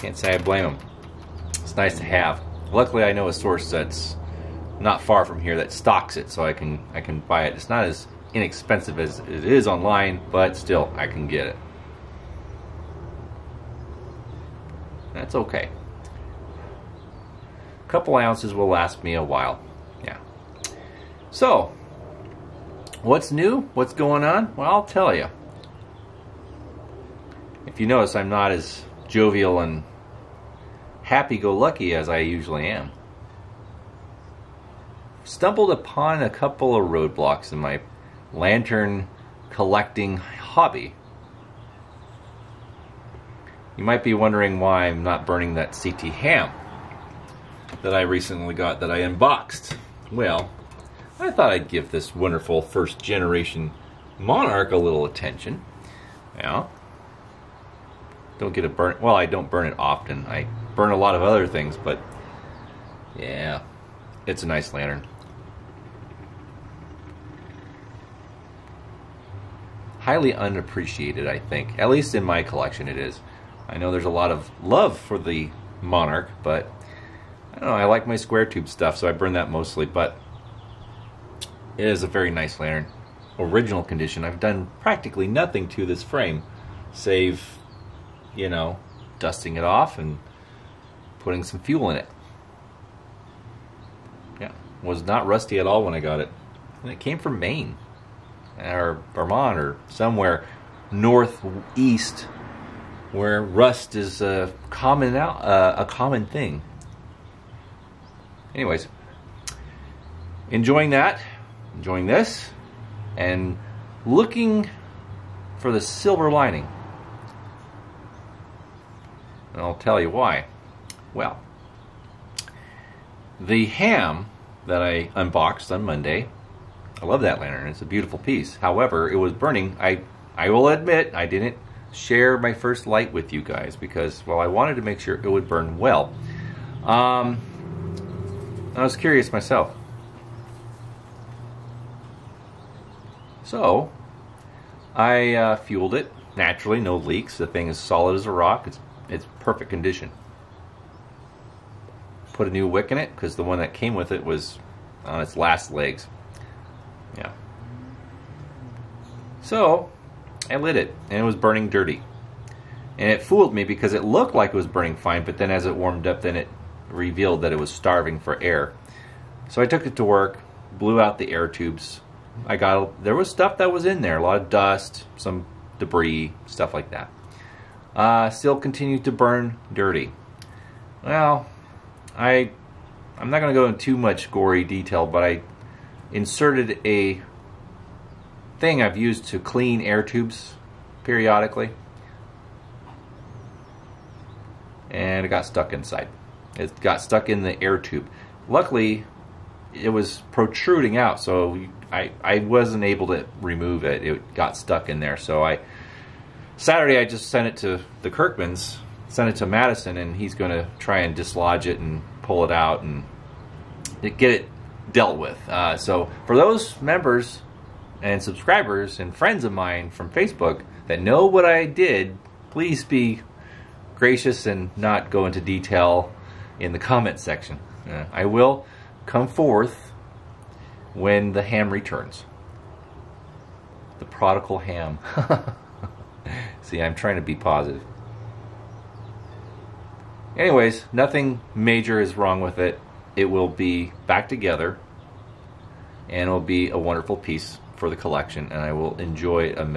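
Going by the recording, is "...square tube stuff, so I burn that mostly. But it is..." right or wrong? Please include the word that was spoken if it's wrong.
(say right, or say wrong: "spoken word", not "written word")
right.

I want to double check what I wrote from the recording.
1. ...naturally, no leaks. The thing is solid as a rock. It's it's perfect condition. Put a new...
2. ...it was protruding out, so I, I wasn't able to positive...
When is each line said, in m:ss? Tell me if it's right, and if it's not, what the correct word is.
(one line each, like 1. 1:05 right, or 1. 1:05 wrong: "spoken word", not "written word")
1. 2:26 right
2. 3:19 wrong: "remove", not "positive".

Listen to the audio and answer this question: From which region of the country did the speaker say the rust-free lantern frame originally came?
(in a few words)
Maine or Vermont.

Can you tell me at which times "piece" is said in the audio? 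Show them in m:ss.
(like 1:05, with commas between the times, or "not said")
2:08, 4:07.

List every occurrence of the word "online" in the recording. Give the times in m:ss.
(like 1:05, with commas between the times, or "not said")
0:09.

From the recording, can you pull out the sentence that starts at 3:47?
Uh, I will come forth when the ham returns.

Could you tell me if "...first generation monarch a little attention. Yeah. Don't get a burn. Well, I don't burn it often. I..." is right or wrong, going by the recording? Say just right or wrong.
right.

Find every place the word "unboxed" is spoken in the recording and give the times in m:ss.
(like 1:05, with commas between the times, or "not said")
0:49, 2:05.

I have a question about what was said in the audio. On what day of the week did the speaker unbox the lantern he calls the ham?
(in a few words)
Monday.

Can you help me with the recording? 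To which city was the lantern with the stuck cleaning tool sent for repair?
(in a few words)
Madison.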